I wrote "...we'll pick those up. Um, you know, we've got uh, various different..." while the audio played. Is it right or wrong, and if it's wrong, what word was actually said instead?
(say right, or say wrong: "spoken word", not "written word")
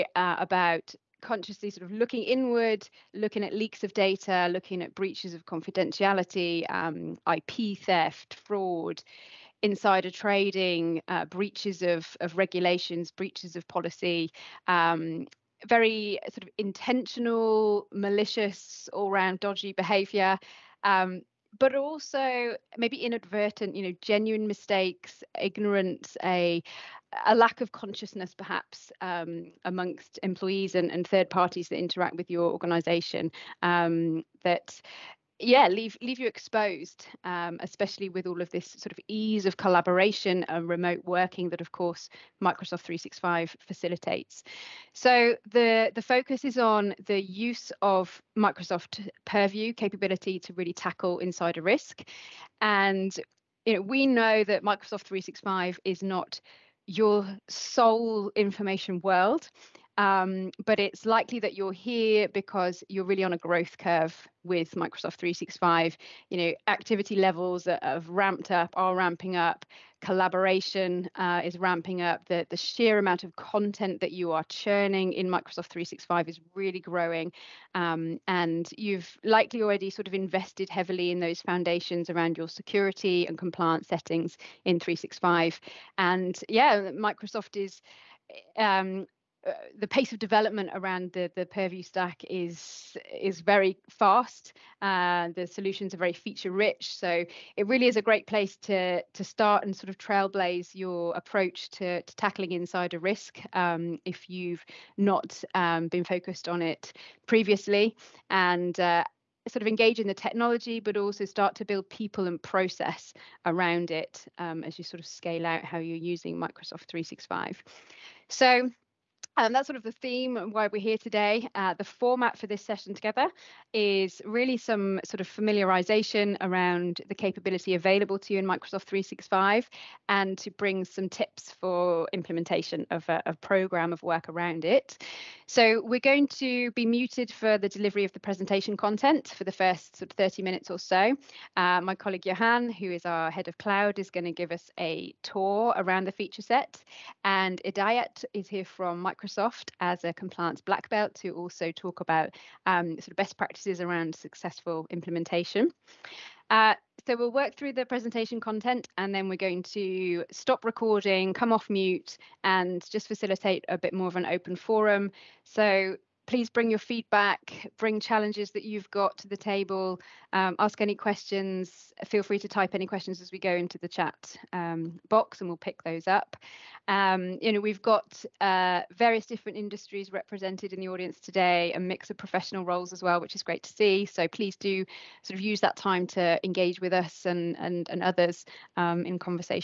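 right.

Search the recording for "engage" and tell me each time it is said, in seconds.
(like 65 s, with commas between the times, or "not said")
109 s, 186 s.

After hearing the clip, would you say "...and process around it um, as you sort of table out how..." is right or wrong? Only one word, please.
wrong.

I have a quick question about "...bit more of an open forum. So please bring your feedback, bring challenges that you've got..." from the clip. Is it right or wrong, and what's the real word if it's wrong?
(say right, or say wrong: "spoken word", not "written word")
right.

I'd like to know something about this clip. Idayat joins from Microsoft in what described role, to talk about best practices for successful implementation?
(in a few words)
Compliance black belt.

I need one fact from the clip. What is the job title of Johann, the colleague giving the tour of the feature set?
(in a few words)
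Head of cloud.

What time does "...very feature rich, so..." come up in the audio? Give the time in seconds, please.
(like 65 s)
95 s.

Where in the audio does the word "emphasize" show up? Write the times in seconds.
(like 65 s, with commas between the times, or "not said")
not said.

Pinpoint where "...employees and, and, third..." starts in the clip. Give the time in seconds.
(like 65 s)
30 s.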